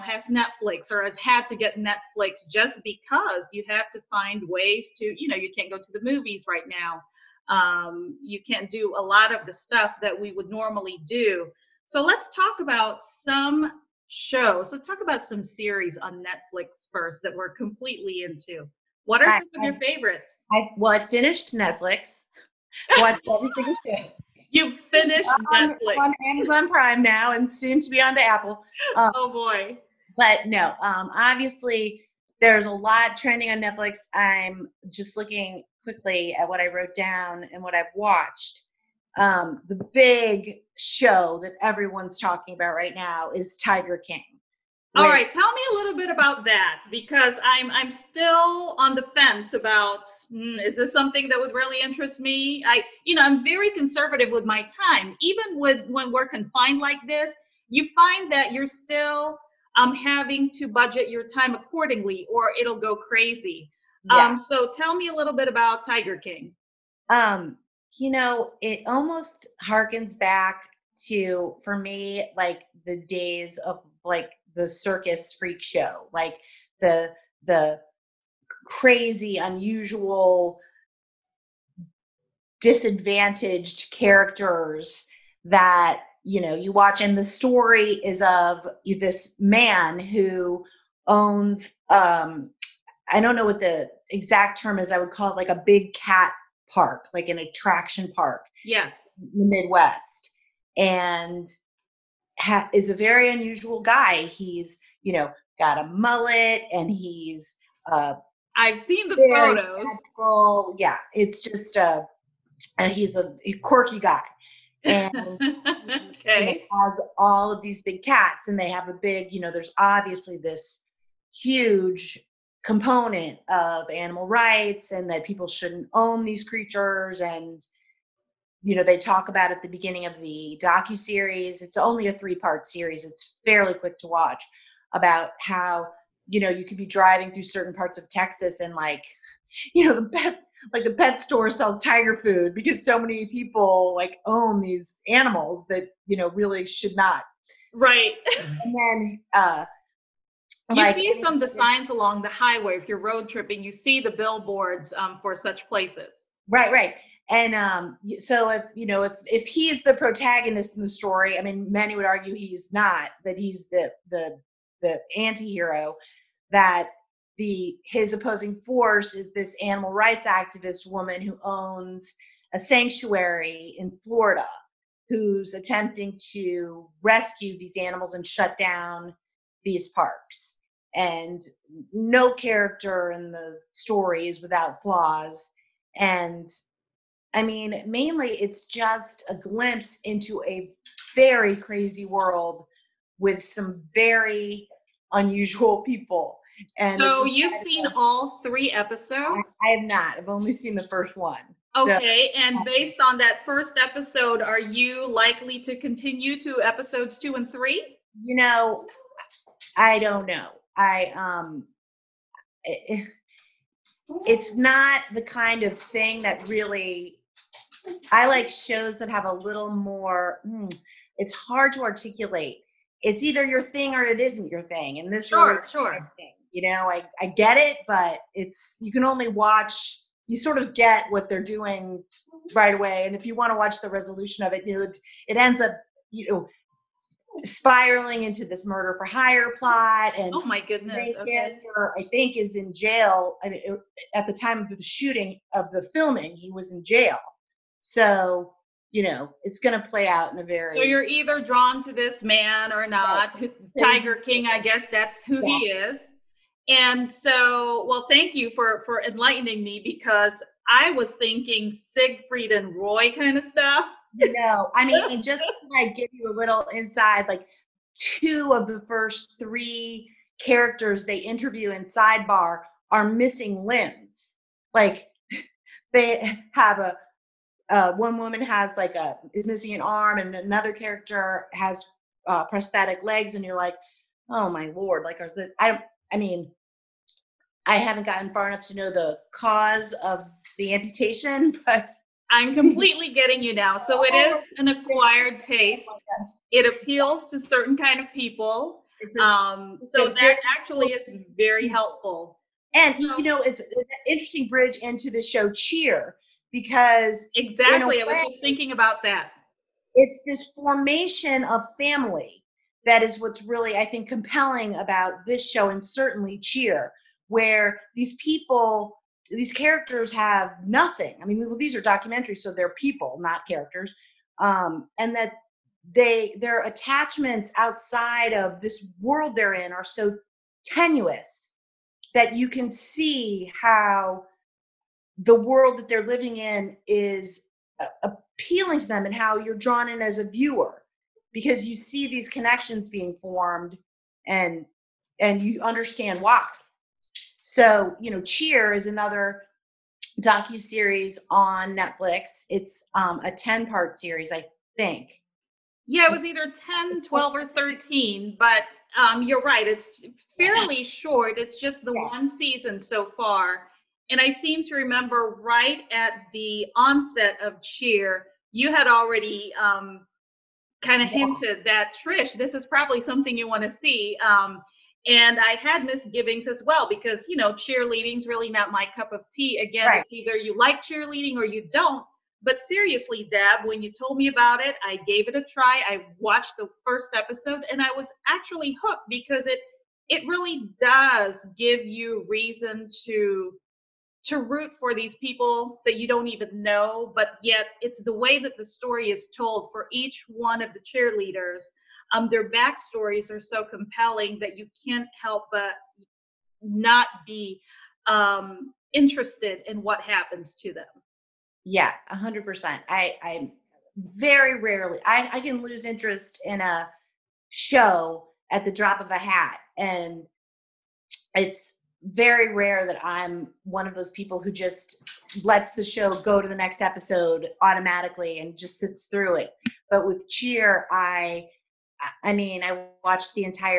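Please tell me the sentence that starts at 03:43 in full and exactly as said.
It's either your thing or it isn't your thing.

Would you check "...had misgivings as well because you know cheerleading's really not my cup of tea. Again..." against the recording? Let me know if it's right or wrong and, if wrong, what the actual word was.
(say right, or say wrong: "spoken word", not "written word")
right.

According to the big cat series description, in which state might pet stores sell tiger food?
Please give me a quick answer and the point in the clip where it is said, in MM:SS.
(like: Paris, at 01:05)
Texas, at 02:18.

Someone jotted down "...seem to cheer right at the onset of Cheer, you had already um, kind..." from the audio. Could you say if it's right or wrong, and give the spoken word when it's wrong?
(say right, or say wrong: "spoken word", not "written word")
wrong: "remember", not "cheer".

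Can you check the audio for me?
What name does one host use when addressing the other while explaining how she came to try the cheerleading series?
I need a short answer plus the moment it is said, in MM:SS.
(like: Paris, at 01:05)
Deb, at 06:23.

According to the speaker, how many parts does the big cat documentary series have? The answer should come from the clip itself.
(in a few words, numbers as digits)
3.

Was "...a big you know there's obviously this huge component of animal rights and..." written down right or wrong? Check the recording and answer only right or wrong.
right.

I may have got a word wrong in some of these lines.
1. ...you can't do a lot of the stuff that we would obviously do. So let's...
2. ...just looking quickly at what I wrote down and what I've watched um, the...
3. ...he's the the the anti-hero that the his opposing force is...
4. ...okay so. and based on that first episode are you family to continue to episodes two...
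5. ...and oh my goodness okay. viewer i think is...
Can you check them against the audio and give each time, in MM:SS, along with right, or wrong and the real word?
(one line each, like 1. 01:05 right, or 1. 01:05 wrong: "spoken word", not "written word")
1. 00:08 wrong: "normally", not "obviously"
2. 00:34 right
3. 02:43 right
4. 03:21 wrong: "likely", not "family"
5. 04:00 wrong: "character", not "viewer".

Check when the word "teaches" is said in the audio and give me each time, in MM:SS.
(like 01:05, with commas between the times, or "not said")
not said.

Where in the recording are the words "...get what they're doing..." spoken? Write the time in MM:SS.
03:50.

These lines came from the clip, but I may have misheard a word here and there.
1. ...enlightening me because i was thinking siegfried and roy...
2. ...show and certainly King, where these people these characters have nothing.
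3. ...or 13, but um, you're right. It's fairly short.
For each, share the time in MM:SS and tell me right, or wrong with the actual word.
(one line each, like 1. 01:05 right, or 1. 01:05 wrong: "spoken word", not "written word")
1. 04:19 right
2. 05:15 wrong: "Cheer", not "King"
3. 05:57 right.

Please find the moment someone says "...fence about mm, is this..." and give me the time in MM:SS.
00:49.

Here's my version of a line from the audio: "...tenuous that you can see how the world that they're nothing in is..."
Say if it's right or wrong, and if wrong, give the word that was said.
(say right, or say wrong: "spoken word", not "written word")
wrong: "living", not "nothing".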